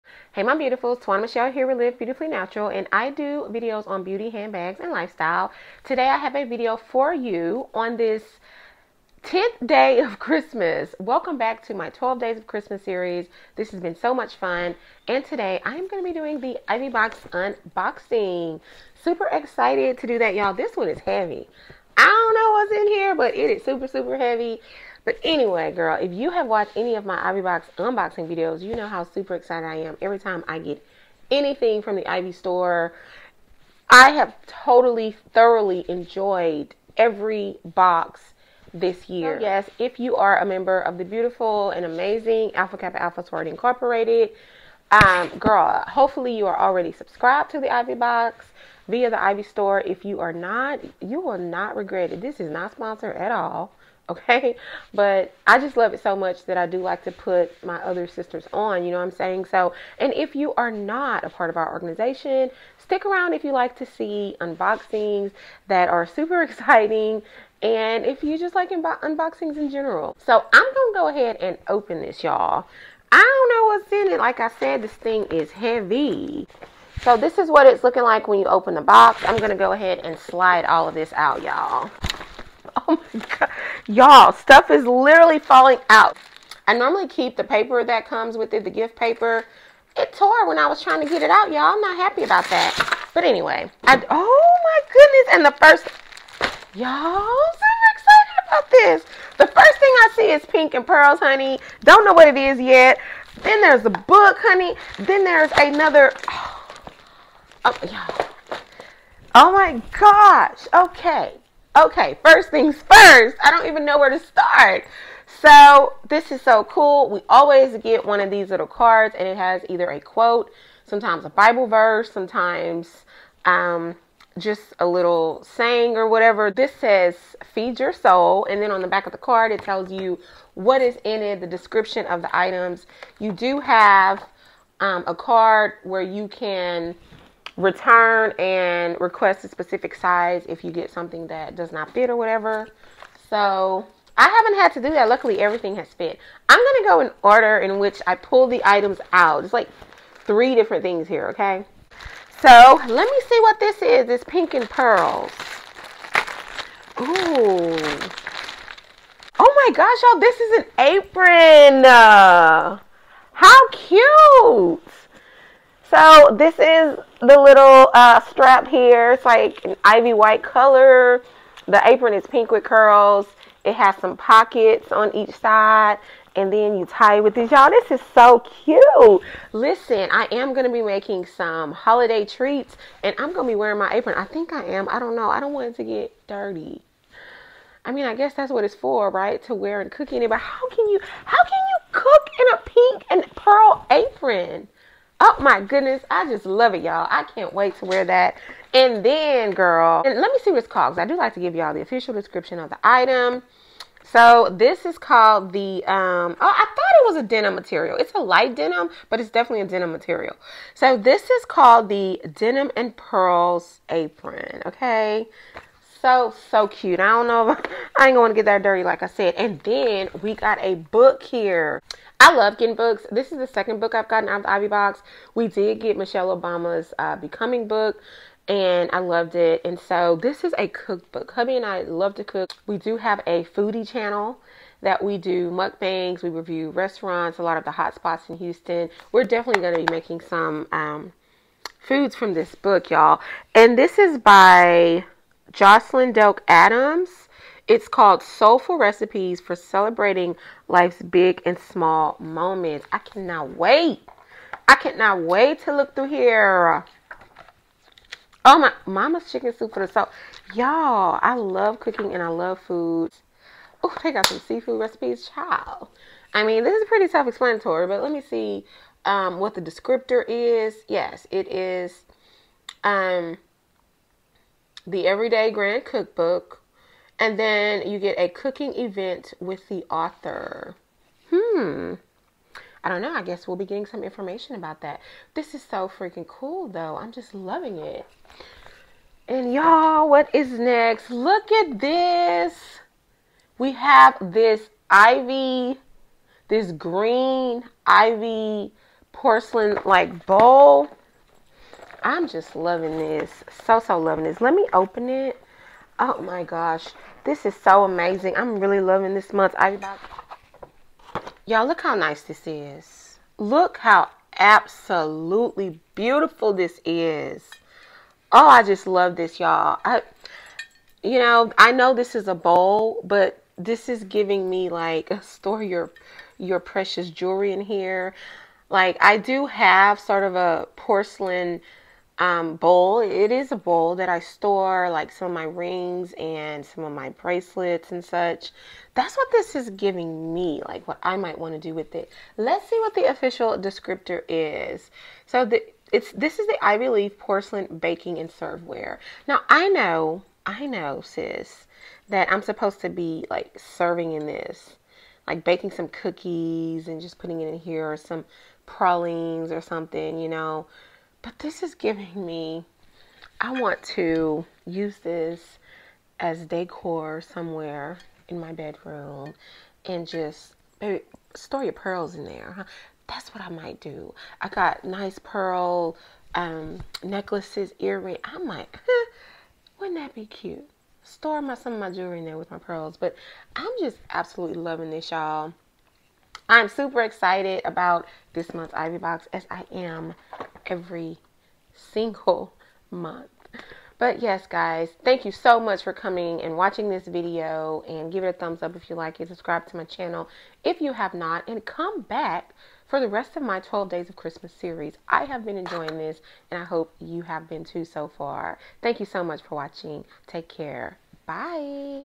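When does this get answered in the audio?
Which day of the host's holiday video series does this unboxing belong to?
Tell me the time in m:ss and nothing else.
0:09.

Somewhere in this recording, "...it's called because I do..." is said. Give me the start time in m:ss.
3:20.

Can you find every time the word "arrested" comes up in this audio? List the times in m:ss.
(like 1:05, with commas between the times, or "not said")
not said.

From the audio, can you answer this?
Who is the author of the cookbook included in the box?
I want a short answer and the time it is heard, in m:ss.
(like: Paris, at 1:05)
Jocelyn Delk Adams, at 4:05.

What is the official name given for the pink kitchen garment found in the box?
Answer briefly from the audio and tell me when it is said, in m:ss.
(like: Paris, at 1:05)
Denim and Pearls apron, at 3:32.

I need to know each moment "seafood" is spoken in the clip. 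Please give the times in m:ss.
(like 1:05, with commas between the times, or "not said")
4:24.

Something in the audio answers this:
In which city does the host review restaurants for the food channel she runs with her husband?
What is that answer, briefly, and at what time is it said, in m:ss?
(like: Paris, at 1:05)
Houston, at 3:58.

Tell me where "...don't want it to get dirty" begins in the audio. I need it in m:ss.
3:05.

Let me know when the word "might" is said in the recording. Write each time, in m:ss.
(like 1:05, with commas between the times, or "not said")
5:41, 6:13, 6:18.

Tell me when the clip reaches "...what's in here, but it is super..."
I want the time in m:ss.
0:22.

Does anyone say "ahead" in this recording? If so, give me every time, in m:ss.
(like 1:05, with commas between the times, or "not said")
1:11, 1:19.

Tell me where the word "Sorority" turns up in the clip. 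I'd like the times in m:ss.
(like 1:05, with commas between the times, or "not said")
0:43.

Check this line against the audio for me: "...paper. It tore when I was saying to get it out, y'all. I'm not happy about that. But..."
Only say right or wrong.
wrong.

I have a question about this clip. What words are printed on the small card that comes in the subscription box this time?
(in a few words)
Feed your soul.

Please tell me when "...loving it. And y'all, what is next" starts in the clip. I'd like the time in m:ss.
4:47.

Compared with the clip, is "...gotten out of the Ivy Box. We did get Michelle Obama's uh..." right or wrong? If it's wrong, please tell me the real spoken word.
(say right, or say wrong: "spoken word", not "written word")
right.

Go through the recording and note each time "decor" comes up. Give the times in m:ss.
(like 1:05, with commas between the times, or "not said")
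6:06.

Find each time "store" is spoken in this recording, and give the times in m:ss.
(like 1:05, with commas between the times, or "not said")
0:32, 0:49, 5:25, 5:34, 6:11, 6:21.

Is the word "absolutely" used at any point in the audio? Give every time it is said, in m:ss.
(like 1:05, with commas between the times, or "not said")
5:14, 6:24.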